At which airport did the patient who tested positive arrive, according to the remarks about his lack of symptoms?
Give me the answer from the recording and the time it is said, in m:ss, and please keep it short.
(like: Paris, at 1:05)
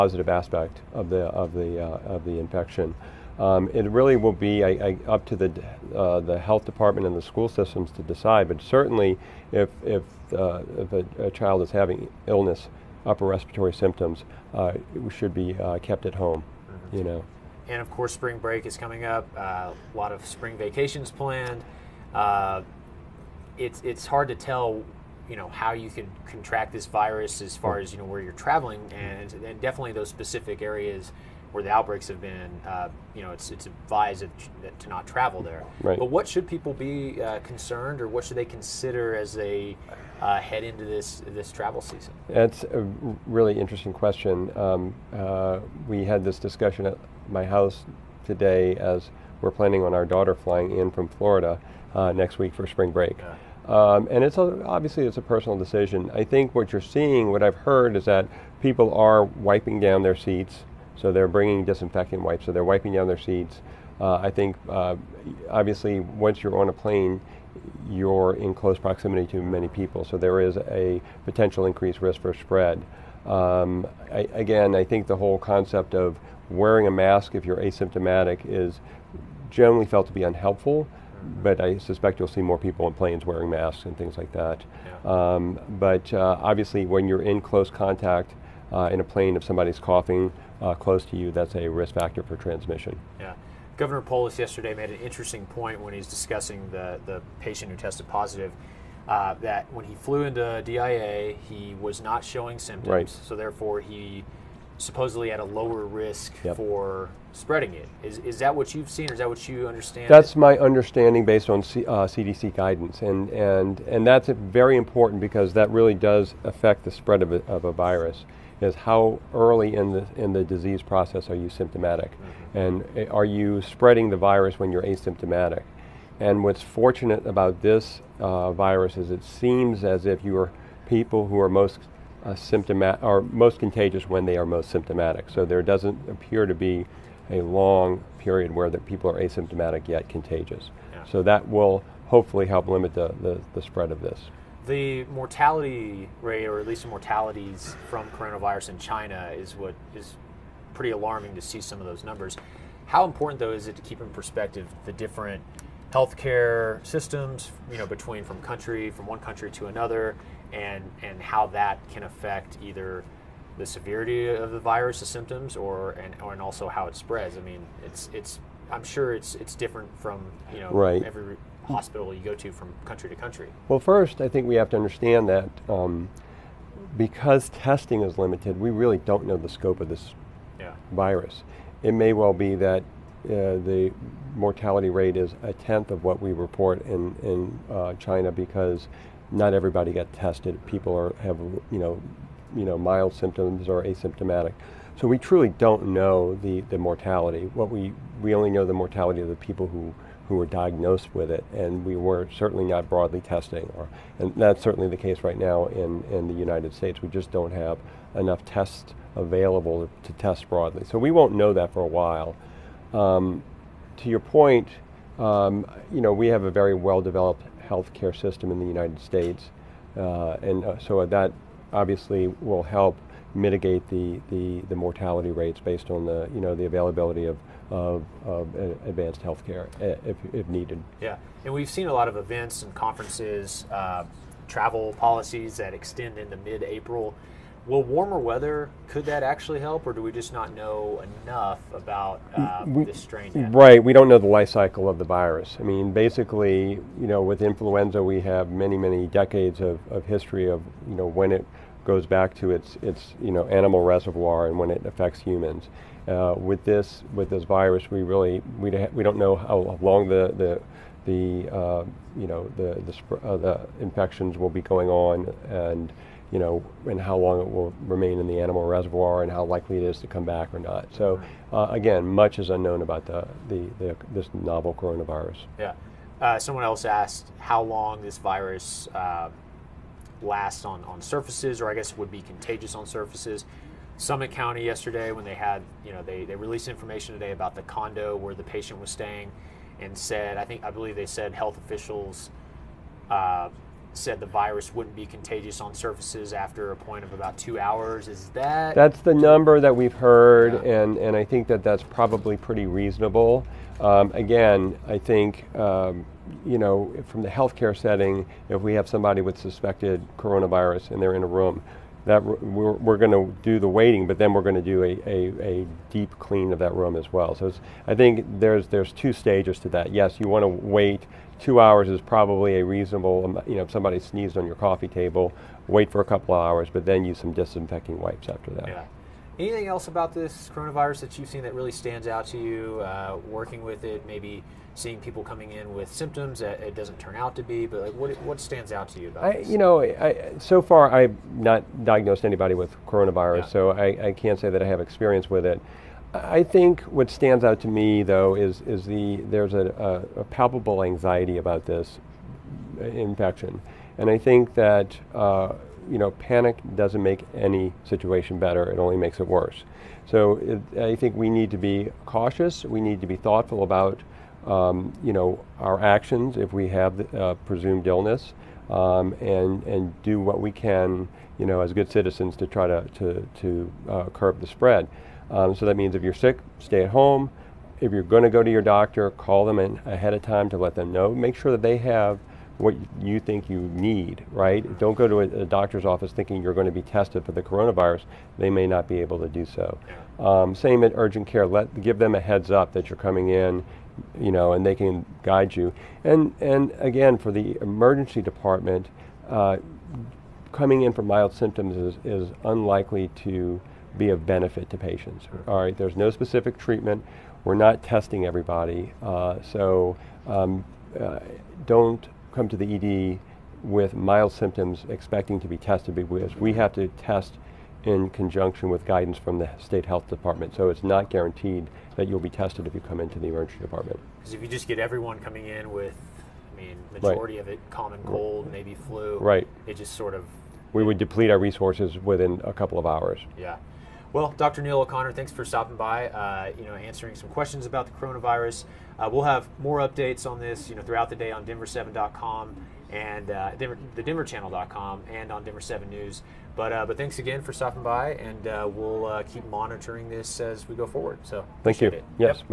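DIA, at 1:40.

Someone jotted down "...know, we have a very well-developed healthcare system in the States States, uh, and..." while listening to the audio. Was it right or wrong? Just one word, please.
wrong.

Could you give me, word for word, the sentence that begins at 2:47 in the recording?
I mean, it's it's I'm sure it's it's different from you know right.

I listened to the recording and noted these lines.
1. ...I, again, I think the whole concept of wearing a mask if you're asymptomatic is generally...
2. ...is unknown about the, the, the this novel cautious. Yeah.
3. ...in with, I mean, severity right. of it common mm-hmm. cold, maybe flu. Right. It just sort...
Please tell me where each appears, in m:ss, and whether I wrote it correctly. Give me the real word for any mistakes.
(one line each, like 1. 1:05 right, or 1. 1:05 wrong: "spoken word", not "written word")
1. 1:14 right
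2. 4:32 wrong: "coronavirus", not "cautious"
3. 7:05 wrong: "majority", not "severity".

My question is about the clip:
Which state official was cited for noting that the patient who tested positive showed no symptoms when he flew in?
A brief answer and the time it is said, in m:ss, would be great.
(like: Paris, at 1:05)
Governor Polis, at 1:33.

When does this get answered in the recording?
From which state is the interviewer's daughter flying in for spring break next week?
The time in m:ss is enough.
0:51.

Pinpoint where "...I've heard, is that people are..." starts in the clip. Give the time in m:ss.
0:57.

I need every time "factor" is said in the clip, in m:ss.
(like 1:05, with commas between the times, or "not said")
1:31.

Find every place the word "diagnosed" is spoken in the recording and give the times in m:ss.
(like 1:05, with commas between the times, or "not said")
3:20, 5:41.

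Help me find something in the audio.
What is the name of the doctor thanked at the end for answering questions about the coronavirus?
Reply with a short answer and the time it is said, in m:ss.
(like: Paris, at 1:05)
Neal O'Connor, at 7:14.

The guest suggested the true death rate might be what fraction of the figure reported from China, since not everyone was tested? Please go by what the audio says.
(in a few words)
a tenth.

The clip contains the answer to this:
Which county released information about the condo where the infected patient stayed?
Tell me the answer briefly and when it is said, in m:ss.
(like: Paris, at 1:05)
Summit County, at 4:43.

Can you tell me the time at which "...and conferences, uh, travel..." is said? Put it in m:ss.
3:52.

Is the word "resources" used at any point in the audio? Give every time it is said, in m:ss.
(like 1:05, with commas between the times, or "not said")
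7:11.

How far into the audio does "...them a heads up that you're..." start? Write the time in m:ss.
6:31.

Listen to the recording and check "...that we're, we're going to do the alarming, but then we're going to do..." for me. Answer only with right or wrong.
wrong.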